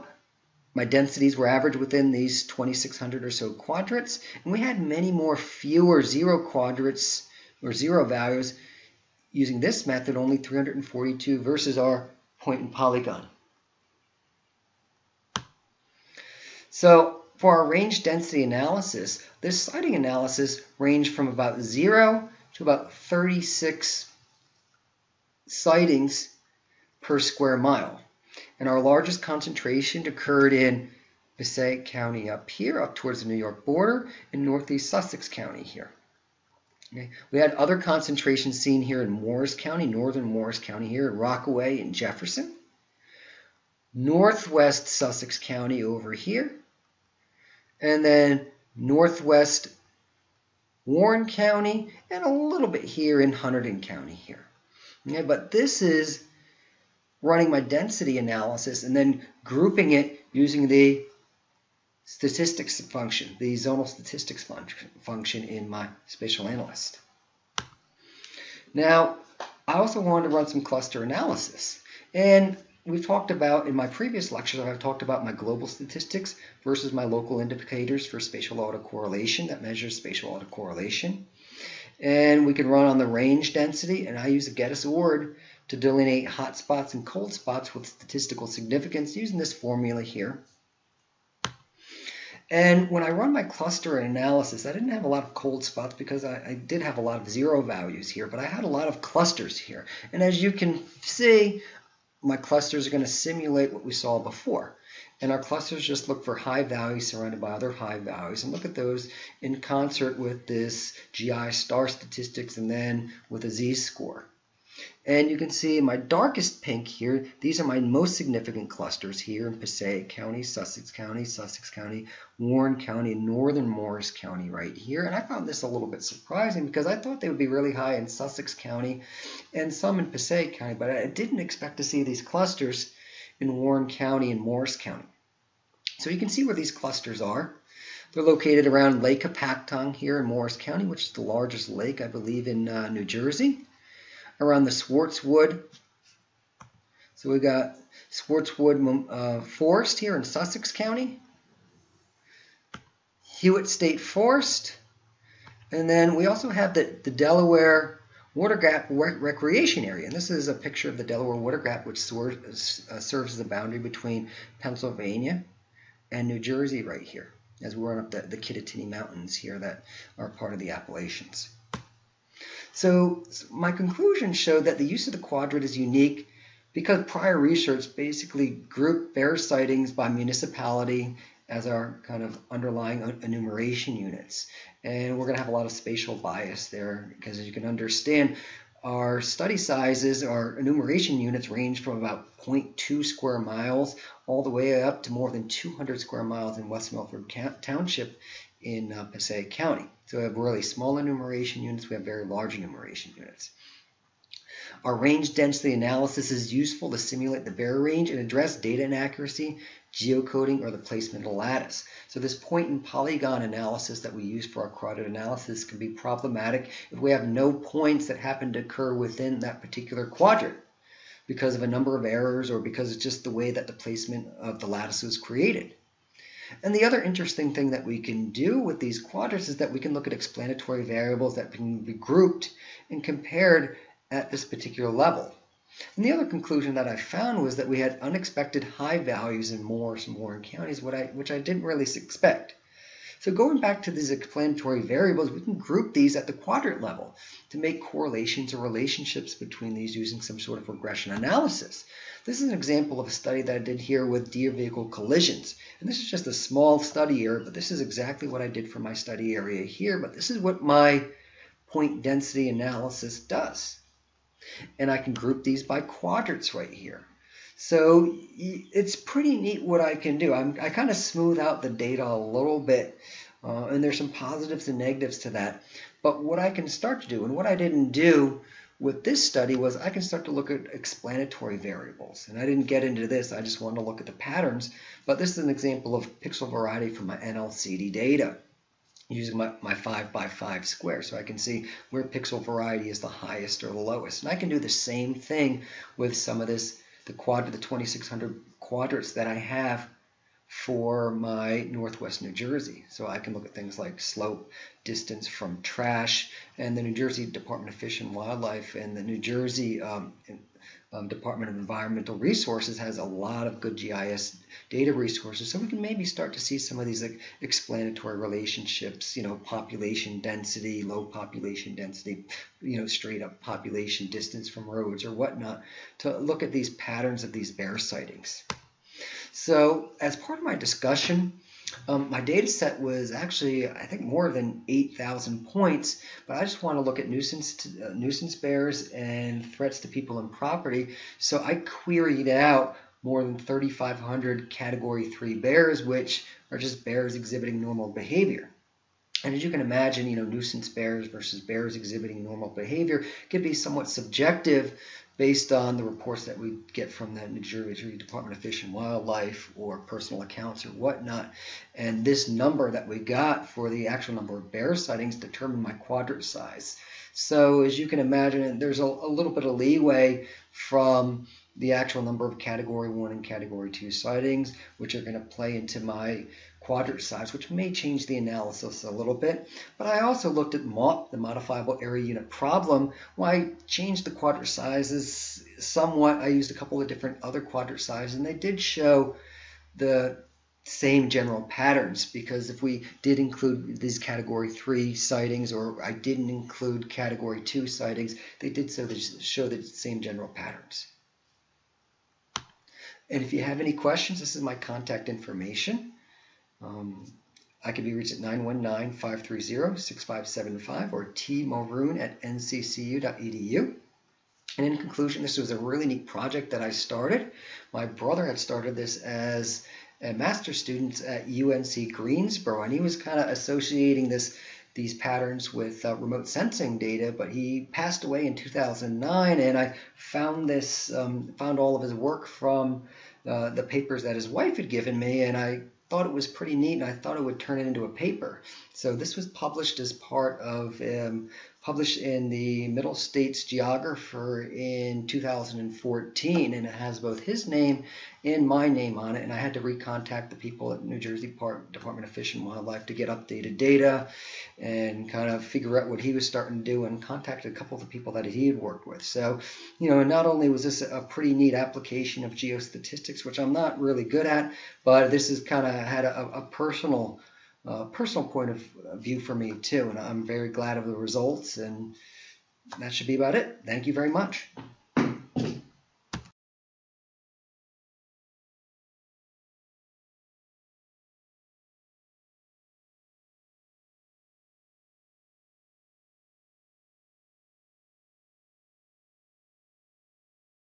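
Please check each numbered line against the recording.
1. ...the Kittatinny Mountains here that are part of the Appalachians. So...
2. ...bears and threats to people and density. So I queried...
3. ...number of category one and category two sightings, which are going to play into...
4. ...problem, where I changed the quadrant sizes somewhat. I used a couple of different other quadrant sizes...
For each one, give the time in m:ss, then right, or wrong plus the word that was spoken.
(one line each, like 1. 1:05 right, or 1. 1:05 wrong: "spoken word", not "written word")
1. 2:48 right
2. 5:38 wrong: "property", not "density"
3. 6:12 right
4. 6:22 right.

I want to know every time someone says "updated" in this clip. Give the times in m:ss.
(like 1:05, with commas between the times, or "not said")
7:33.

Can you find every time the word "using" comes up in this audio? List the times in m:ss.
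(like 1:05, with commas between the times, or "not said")
0:09, 1:00, 1:29, 4:09, 4:49.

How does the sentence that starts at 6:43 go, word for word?
And if you have any questions, this is my contact information.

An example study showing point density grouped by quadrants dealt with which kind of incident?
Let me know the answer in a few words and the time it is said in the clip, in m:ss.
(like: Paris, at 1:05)
deer vehicle collisions, at 4:14.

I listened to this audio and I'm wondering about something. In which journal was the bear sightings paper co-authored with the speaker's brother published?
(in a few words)
Middle States Geographer.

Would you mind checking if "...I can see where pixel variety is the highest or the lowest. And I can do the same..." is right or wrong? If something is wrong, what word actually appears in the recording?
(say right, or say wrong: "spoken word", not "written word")
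right.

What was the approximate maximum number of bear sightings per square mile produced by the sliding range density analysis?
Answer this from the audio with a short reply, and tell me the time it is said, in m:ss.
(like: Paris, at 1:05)
36, at 0:22.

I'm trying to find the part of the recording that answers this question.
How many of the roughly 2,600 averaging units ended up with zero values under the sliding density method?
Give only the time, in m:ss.
0:10.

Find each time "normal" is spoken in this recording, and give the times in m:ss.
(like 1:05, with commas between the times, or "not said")
5:47, 5:52.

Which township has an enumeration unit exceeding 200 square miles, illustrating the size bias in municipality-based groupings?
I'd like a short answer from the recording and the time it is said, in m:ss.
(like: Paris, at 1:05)
West Milford Township, at 3:16.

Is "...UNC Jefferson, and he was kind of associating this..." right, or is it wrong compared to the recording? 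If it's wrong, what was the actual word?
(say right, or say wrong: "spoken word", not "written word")
wrong: "Greensboro", not "Jefferson".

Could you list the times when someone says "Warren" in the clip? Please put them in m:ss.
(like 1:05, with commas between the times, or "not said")
0:50, 2:02, 2:13, 4:00.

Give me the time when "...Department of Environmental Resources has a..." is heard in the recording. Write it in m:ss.
5:11.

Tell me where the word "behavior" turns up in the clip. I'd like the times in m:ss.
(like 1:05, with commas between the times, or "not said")
5:47, 5:52.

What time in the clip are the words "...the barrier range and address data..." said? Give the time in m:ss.
3:27.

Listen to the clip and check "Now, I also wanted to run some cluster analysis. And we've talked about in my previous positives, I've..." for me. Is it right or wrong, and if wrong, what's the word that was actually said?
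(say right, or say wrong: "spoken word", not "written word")
wrong: "lectures", not "positives".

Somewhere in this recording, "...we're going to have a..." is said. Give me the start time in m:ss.
3:05.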